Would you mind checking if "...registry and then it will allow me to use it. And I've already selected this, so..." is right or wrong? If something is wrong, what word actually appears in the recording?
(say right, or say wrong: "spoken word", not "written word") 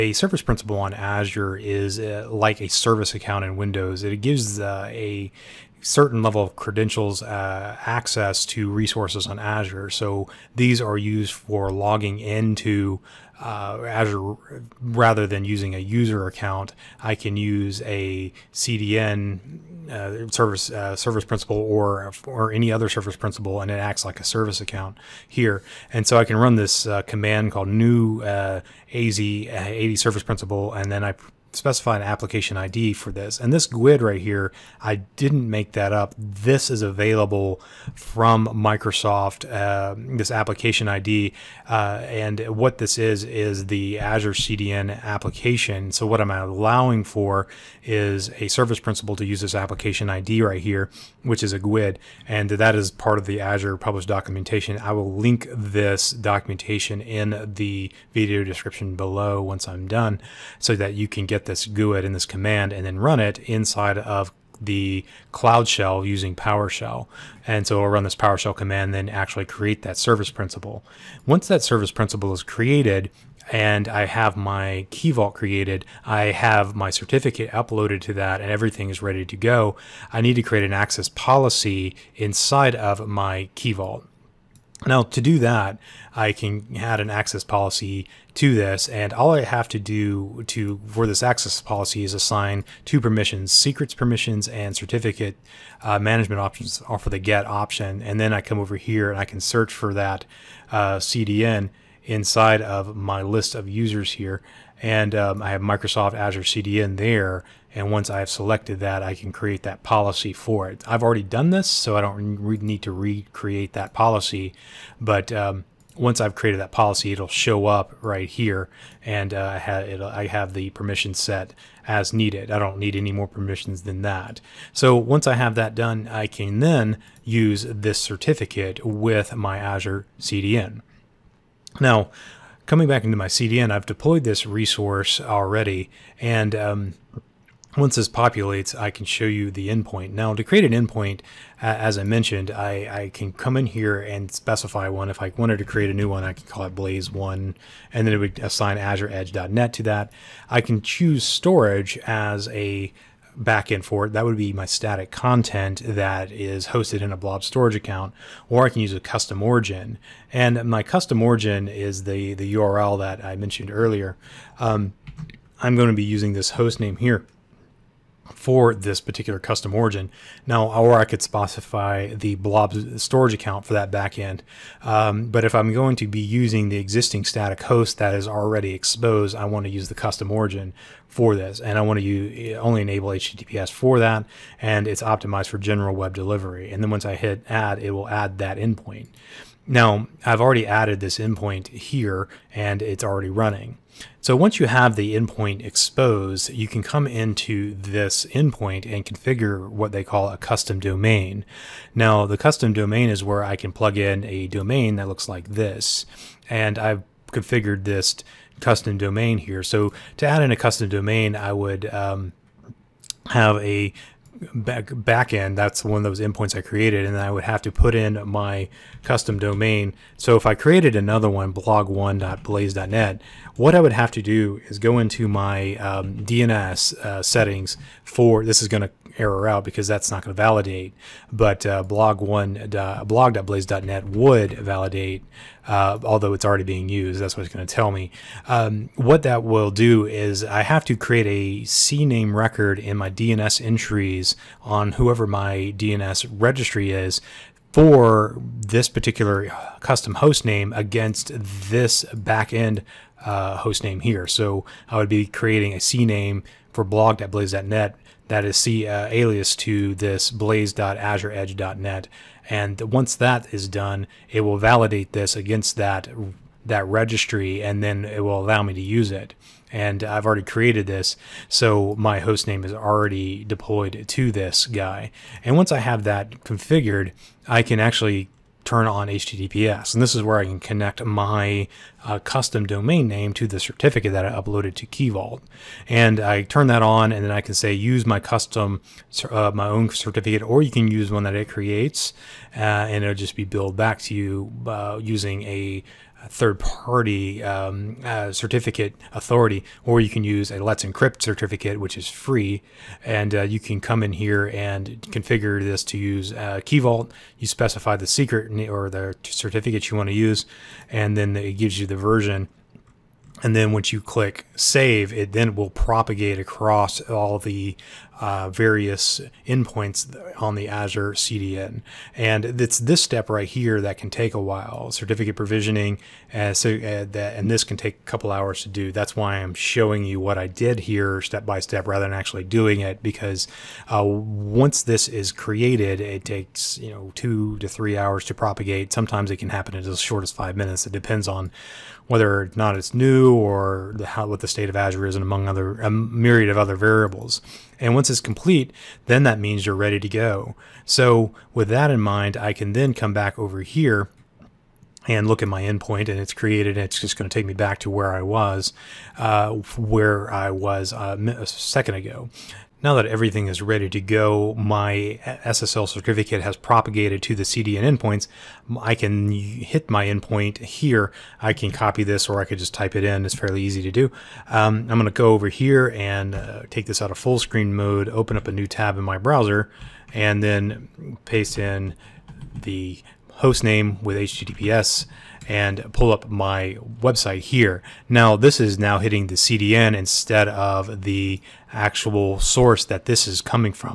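wrong: "created", not "selected".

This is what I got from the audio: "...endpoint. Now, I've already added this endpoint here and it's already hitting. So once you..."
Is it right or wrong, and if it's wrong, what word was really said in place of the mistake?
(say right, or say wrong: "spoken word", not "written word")
wrong: "running", not "hitting".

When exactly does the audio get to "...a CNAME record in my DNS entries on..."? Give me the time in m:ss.
4:01.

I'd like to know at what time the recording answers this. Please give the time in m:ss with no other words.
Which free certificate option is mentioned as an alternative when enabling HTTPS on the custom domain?
5:00.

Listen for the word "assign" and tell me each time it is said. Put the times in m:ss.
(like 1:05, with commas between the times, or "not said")
1:32, 2:28.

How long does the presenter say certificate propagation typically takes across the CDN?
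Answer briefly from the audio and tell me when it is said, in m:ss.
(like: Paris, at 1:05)
2 to 3 hours, at 5:37.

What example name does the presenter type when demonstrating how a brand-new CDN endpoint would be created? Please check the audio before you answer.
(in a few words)
Blaze1.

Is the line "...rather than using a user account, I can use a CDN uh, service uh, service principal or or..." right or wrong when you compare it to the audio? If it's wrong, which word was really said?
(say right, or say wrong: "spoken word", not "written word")
right.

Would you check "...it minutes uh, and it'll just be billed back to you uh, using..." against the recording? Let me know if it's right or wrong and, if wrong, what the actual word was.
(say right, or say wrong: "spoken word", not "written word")
wrong: "creates", not "minutes".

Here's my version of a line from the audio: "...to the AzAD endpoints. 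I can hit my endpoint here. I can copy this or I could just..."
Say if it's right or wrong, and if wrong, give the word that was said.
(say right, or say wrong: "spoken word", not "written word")
wrong: "CDN", not "AzAD".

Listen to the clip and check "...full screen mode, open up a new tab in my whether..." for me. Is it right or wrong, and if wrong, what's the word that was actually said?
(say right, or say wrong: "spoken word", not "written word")
wrong: "browser", not "whether".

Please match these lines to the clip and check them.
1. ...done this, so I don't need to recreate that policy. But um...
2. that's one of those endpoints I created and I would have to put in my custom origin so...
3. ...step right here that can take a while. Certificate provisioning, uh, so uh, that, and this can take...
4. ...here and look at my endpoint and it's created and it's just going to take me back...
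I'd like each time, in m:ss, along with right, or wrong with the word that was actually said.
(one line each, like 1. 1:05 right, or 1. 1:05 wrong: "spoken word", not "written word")
1. 1:51 right
2. 3:35 wrong: "domain", not "origin"
3. 5:22 right
4. 5:53 right.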